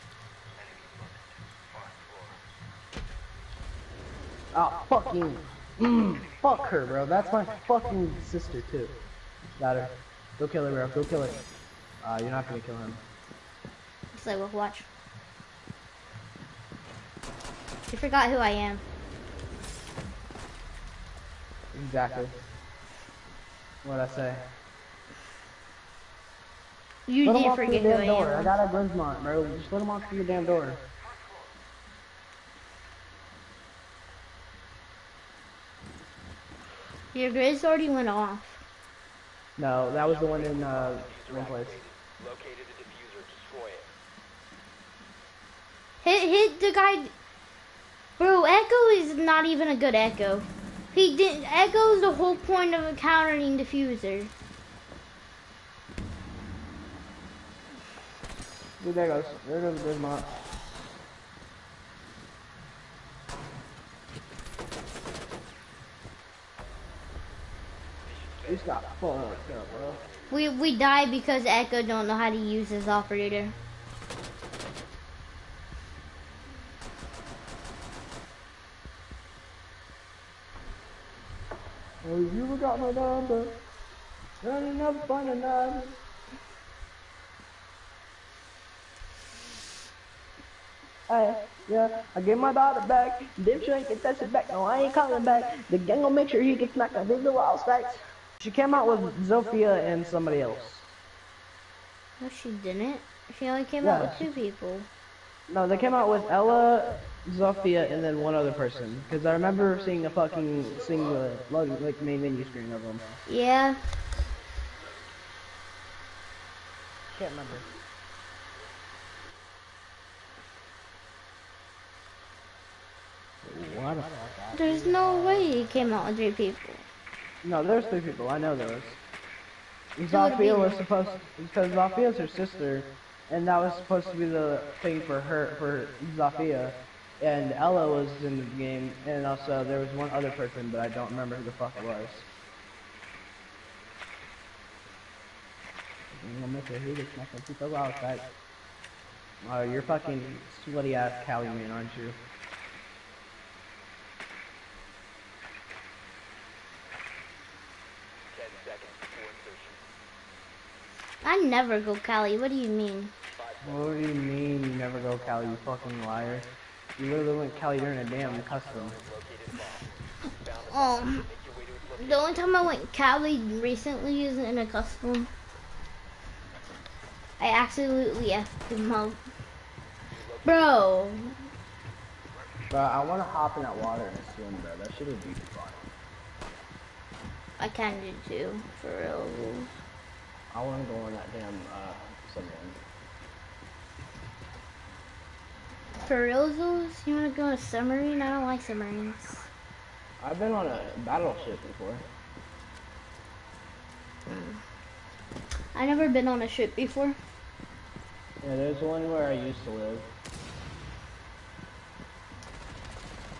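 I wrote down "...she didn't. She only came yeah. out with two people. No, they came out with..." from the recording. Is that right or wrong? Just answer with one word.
right.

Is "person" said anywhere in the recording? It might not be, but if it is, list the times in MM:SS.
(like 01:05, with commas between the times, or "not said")
01:48, 02:20.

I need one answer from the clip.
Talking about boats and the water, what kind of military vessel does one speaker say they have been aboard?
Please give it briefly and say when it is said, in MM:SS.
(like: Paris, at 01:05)
battleship, at 03:21.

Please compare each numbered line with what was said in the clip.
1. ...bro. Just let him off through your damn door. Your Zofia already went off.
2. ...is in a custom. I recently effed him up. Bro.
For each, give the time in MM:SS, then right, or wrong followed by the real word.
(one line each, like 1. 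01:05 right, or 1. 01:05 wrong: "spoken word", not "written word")
1. 00:29 wrong: "Grizz", not "Zofia"
2. 02:54 wrong: "absolutely", not "recently".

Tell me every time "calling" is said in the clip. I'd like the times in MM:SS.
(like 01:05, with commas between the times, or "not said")
01:34.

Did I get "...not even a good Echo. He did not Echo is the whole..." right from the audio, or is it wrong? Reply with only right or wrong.
right.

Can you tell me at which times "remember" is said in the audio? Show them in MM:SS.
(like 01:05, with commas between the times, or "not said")
01:49, 01:57, 02:21.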